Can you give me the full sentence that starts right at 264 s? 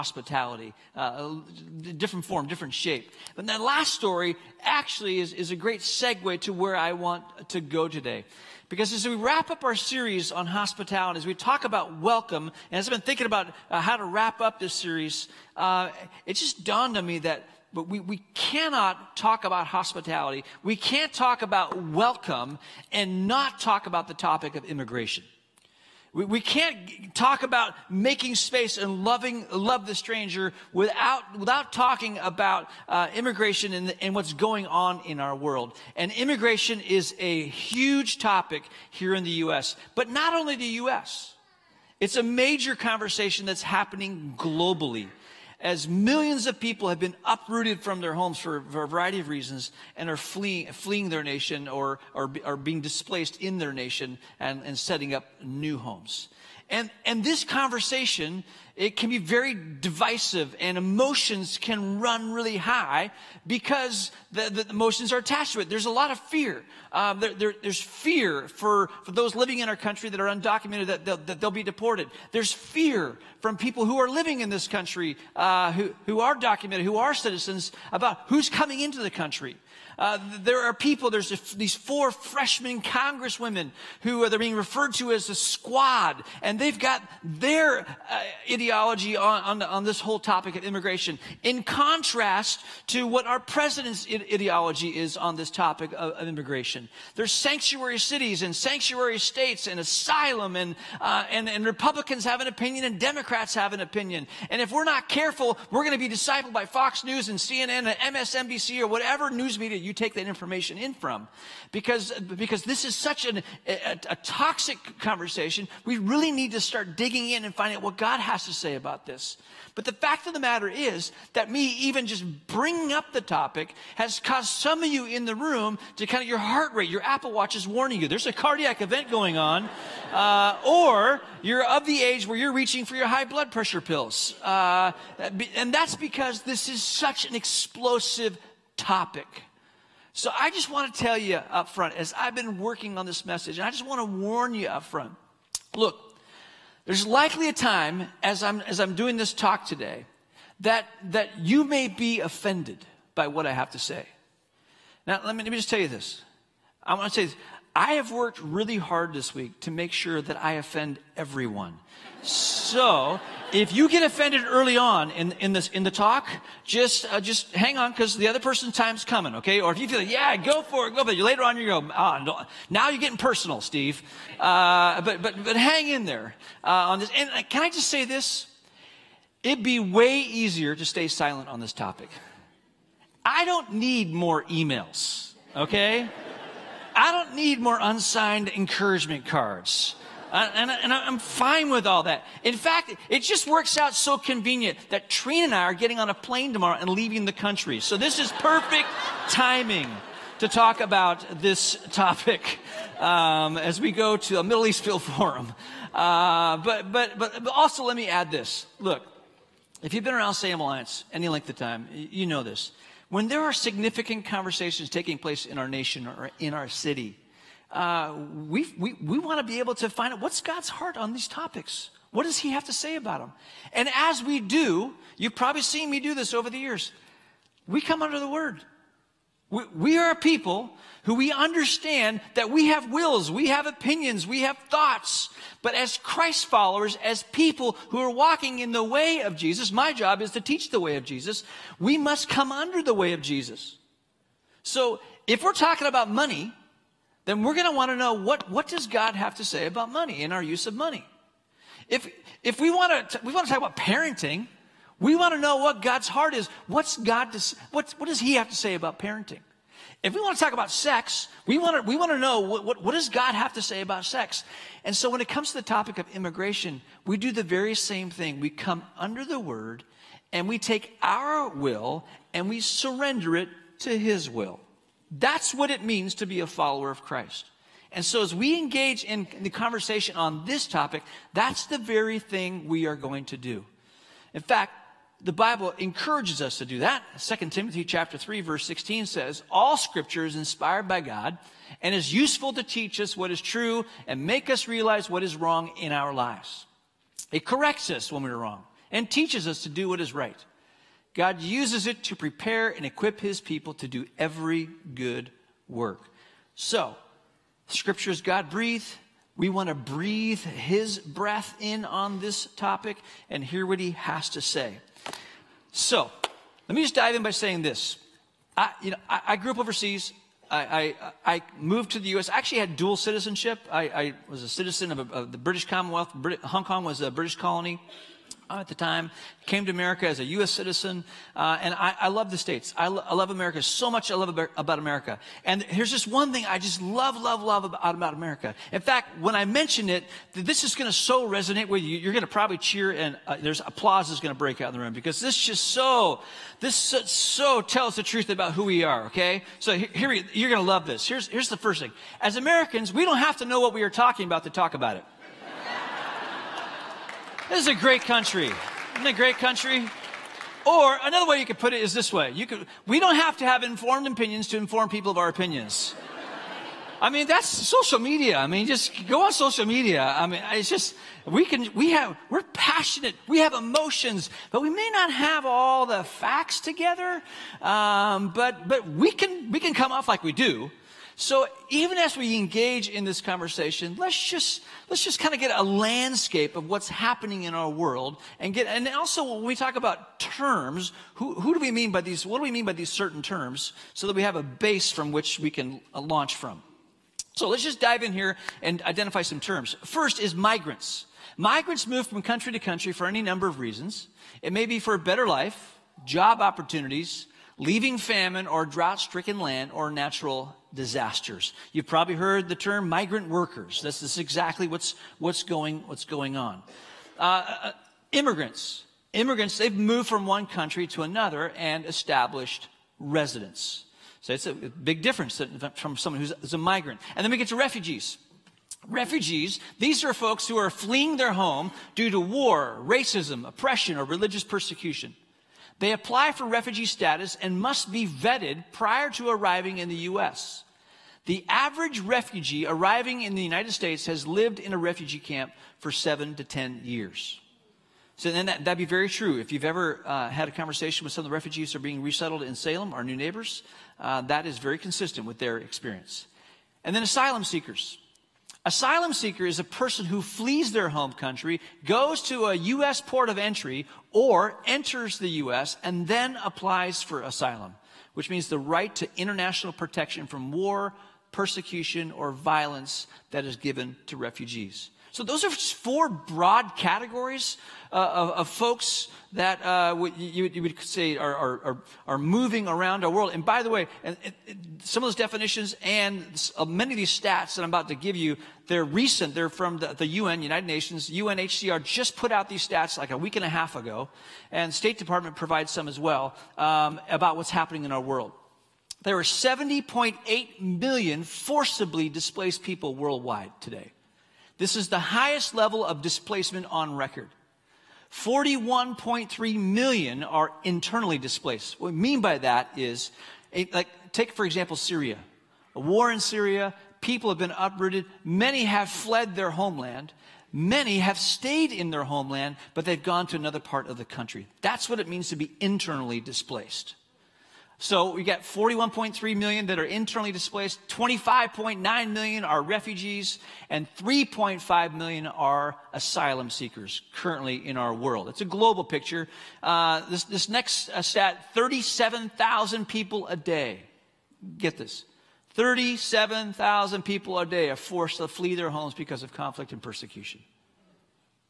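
And so when it comes to the topic of immigration, we do the very same thing.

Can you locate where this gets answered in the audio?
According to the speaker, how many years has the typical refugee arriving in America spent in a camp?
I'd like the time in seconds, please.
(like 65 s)
445 s.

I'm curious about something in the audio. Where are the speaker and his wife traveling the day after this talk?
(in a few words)
Middle East Field Forum.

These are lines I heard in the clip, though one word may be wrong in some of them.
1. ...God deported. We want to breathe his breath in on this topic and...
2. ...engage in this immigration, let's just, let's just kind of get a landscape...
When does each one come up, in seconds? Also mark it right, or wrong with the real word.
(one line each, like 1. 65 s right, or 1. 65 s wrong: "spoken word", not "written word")
1. 308 s wrong: "breathed", not "deported"
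2. 382 s wrong: "conversation", not "immigration".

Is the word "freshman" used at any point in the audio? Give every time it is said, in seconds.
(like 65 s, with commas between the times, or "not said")
82 s.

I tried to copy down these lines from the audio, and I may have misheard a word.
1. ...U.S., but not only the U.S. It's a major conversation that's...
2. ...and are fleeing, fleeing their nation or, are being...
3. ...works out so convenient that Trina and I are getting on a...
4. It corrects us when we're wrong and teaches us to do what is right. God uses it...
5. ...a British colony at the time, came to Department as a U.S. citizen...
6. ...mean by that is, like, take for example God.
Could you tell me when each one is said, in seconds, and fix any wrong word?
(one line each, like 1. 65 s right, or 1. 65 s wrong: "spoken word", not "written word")
1. 39 s right
2. 49 s right
3. 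193 s right
4. 297 s right
5. 326 s wrong: "America", not "Department"
6. 511 s wrong: "Syria", not "God".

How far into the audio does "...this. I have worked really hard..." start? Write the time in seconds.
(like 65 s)
157 s.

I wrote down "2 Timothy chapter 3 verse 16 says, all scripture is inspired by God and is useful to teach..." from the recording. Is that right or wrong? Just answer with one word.
right.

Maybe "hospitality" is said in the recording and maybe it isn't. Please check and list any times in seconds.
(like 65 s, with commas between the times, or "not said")
10 s, 19 s.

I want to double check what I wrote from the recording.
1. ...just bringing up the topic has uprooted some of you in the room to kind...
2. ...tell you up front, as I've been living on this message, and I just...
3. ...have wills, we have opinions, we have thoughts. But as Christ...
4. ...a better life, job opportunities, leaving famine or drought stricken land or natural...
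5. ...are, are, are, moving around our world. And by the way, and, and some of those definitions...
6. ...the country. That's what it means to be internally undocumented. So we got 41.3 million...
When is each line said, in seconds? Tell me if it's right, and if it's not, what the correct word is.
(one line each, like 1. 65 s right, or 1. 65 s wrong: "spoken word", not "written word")
1. 122 s wrong: "caused", not "uprooted"
2. 140 s wrong: "working", not "living"
3. 232 s right
4. 404 s right
5. 481 s right
6. 523 s wrong: "displaced", not "undocumented".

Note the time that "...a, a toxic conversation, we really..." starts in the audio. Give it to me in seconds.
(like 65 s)
113 s.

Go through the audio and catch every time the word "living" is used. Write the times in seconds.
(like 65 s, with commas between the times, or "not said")
69 s, 74 s.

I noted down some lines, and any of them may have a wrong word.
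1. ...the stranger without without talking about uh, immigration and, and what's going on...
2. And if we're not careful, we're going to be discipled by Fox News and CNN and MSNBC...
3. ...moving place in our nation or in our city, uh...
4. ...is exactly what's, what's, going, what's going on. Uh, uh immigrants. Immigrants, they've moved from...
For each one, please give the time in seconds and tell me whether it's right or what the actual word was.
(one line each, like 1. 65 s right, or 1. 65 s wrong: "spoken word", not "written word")
1. 29 s right
2. 104 s right
3. 214 s wrong: "taking", not "moving"
4. 414 s right.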